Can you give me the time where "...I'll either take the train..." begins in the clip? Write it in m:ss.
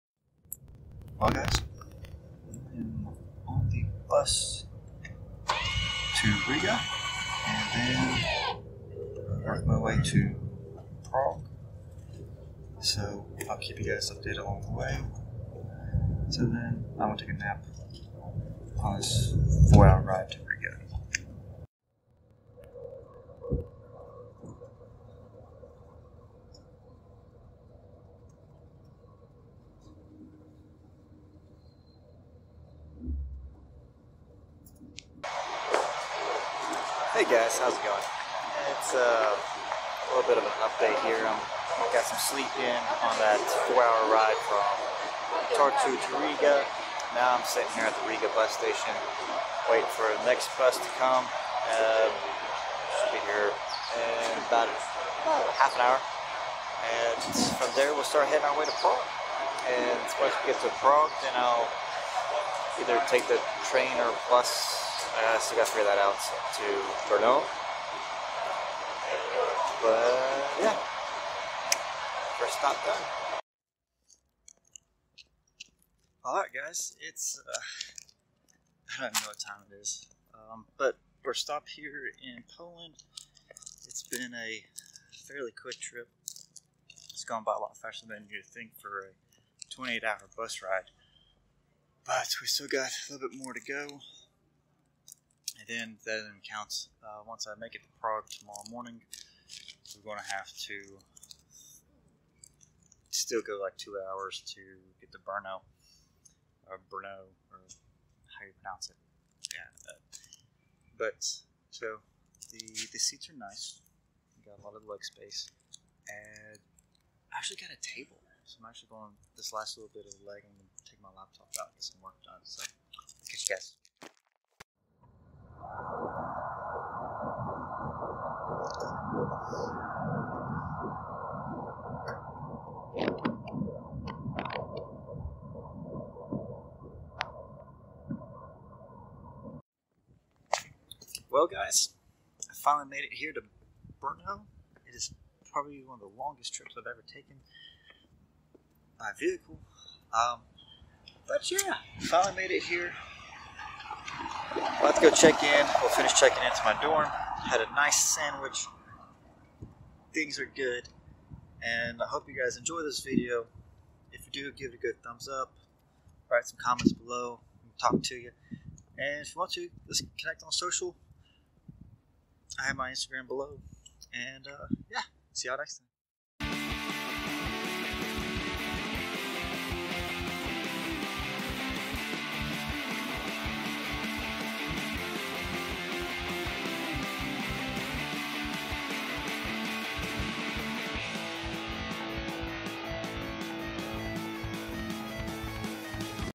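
1:01.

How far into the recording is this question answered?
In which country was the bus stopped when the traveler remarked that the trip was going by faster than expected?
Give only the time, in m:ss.
1:22.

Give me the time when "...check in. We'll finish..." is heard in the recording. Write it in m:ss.
2:35.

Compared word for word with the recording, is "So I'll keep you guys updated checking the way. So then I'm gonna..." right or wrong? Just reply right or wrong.
wrong.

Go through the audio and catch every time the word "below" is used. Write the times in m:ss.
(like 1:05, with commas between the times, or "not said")
2:46, 2:53.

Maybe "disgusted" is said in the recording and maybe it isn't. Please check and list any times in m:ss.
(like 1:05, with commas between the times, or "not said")
not said.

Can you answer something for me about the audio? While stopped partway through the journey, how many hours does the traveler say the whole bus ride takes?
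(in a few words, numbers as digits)
28 hours.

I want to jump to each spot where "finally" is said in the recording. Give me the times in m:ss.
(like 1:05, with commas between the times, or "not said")
2:22, 2:31.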